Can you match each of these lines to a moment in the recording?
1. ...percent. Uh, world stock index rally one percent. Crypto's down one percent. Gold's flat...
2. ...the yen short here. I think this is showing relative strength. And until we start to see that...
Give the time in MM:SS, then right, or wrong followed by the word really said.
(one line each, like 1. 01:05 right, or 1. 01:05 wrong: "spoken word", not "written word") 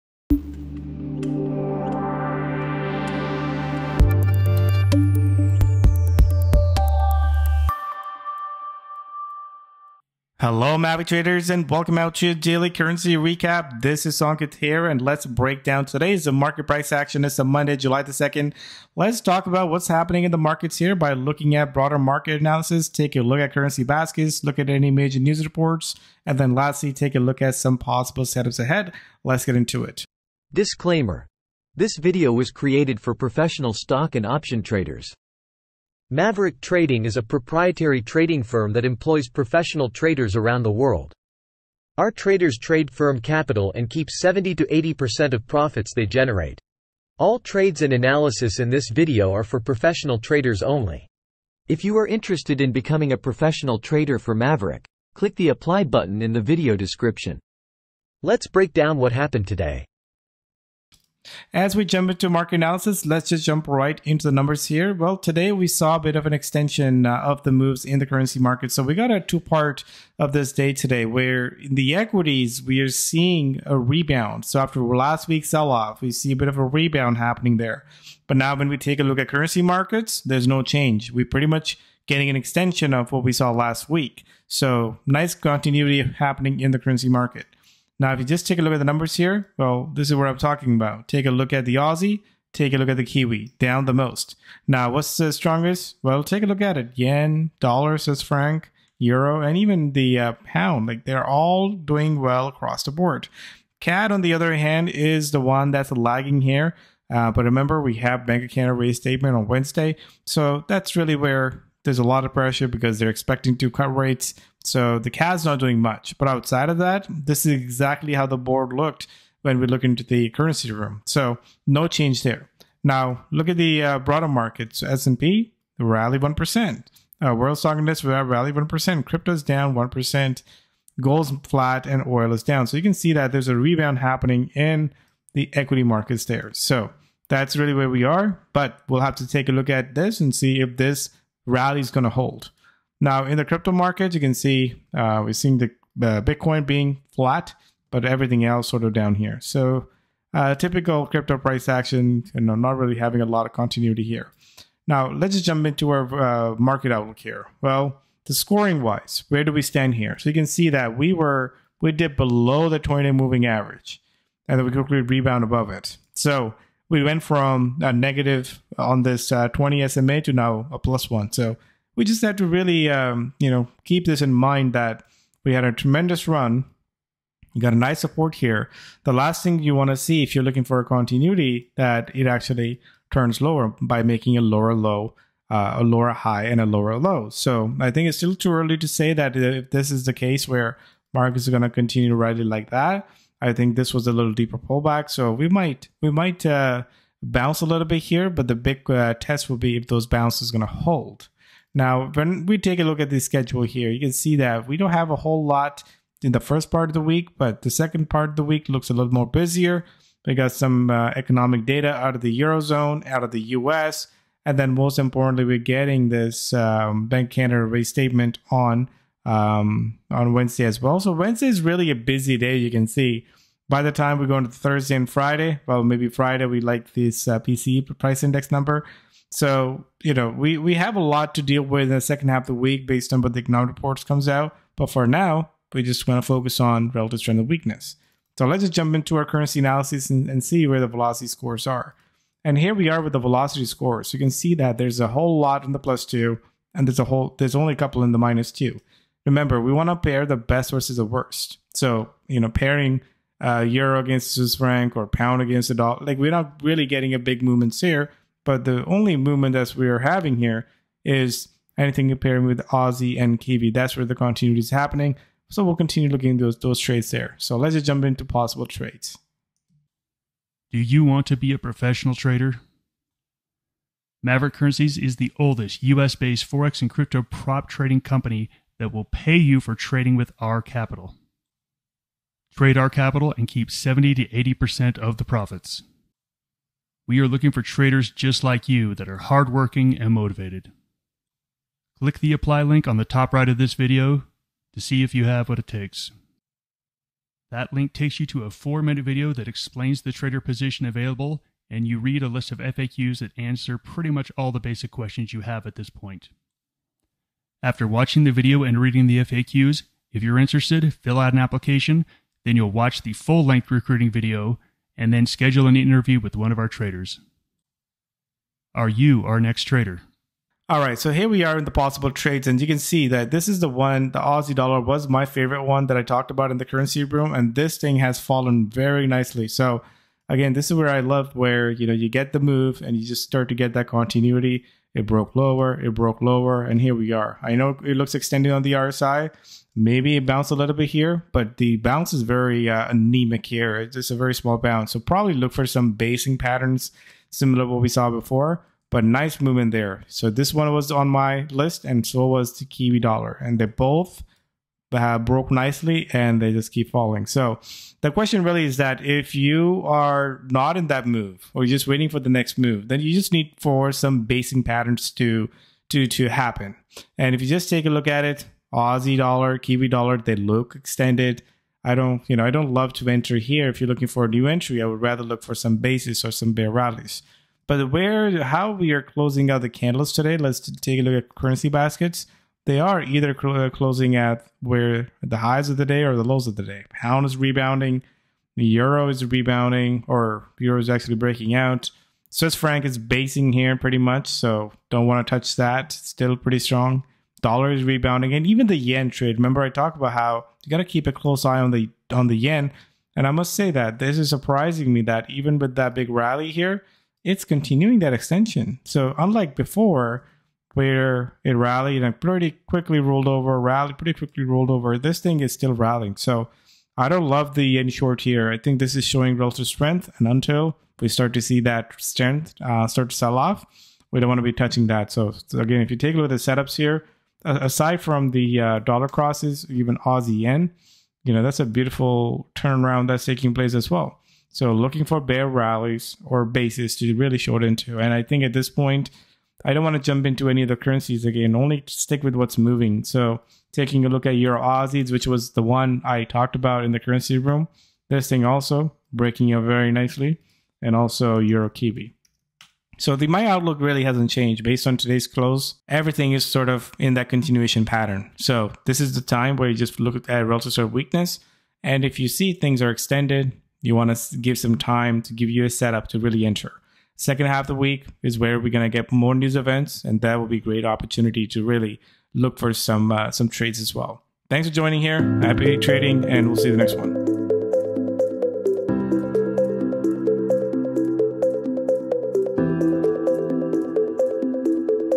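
1. 02:06 right
2. 06:57 right.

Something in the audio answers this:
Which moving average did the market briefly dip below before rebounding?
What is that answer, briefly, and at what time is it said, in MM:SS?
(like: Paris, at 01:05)
20 moving average, at 02:42.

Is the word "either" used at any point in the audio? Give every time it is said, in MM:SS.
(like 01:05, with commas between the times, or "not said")
06:23.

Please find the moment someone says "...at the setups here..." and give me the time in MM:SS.
07:06.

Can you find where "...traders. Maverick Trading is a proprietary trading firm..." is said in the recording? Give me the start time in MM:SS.
00:34.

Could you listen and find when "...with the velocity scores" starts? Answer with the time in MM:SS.
04:03.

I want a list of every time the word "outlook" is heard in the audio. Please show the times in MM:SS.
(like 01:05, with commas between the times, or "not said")
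02:36, 07:33.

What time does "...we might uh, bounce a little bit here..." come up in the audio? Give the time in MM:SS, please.
03:16.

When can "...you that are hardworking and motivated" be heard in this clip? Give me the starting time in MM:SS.
04:48.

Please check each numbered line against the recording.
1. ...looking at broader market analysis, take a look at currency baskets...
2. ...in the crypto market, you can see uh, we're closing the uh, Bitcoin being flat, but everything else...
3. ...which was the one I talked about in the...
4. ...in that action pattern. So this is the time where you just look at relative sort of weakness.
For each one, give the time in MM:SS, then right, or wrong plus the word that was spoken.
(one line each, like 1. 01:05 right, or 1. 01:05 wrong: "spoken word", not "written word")
1. 00:21 right
2. 02:23 wrong: "seeing", not "closing"
3. 07:25 right
4. 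07:36 wrong: "continuation", not "action".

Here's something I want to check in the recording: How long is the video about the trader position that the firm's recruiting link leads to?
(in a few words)
4 minutes.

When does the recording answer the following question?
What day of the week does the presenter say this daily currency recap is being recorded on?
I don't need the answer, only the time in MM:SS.
00:17.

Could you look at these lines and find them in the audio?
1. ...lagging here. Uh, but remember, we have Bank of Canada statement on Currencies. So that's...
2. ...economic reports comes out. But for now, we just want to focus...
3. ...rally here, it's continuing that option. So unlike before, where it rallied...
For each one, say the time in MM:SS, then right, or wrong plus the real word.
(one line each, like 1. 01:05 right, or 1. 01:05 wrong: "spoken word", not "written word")
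1. 01:45 wrong: "Wednesday", not "Currencies"
2. 03:53 right
3. 06:46 wrong: "extension", not "option".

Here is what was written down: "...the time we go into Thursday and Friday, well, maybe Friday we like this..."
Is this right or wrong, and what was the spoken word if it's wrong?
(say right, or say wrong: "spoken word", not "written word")
right.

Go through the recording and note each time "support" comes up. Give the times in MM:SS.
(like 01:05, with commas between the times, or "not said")
02:58.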